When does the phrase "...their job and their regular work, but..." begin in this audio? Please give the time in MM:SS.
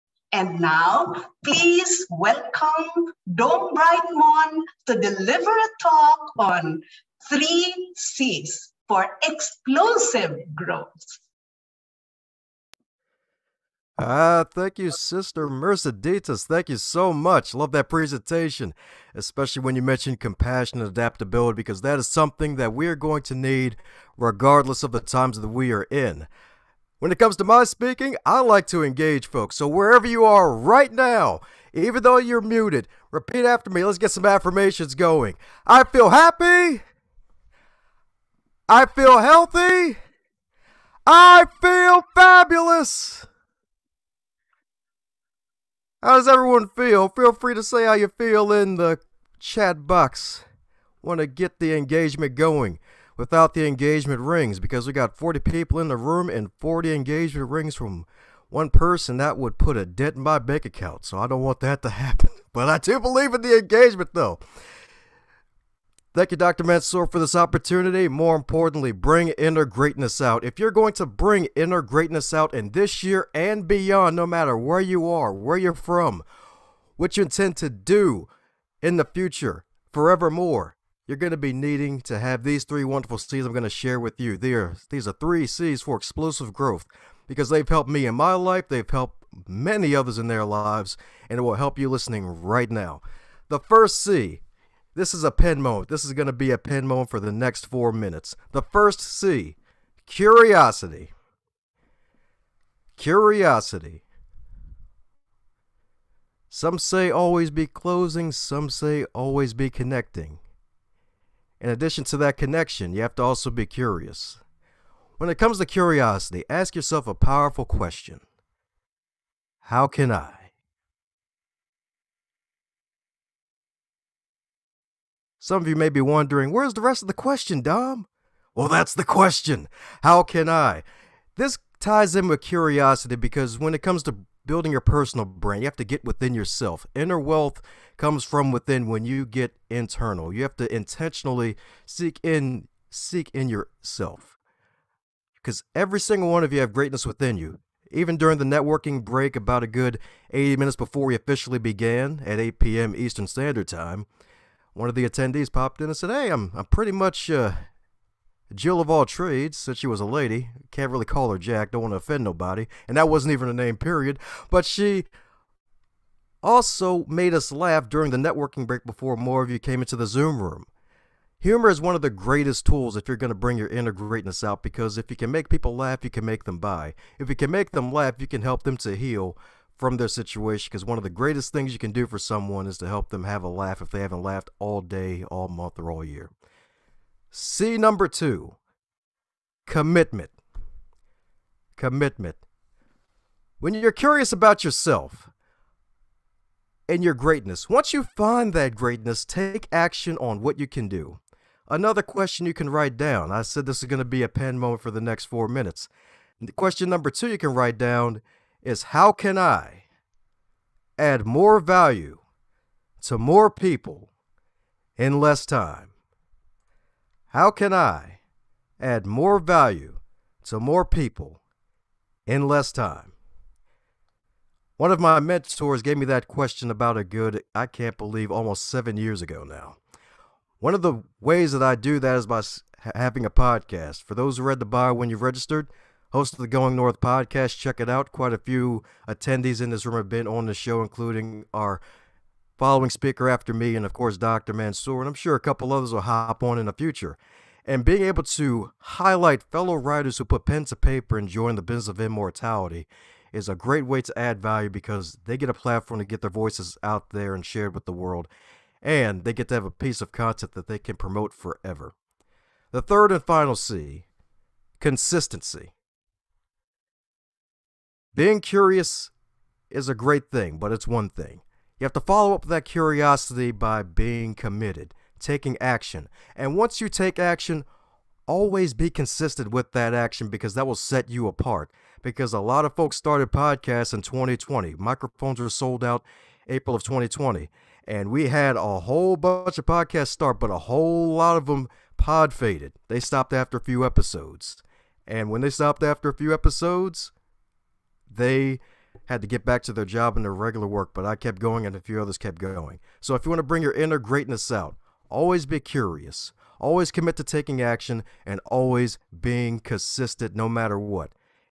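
04:59.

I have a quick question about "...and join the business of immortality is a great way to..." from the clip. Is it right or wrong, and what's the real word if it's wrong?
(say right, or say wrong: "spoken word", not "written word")
right.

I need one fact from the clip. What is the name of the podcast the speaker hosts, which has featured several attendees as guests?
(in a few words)
Going North.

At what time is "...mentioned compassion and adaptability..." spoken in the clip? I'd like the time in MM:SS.
00:19.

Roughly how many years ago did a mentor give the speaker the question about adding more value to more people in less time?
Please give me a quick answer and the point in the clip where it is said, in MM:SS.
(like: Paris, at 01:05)
7, at 03:48.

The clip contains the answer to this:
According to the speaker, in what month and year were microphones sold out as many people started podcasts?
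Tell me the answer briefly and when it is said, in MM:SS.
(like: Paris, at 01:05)
April 2020, at 04:46.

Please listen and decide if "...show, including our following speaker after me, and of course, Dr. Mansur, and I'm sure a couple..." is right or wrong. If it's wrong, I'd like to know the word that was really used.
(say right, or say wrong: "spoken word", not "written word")
right.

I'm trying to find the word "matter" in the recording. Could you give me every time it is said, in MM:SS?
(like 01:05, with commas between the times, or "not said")
01:14, 05:10.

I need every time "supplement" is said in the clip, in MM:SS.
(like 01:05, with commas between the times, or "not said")
not said.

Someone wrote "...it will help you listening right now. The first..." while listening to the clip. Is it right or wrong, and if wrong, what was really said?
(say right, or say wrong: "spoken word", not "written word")
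right.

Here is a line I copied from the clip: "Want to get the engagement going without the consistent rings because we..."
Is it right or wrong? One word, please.
wrong.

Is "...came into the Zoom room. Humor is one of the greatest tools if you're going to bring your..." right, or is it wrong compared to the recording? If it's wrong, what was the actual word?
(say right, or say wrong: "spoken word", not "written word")
right.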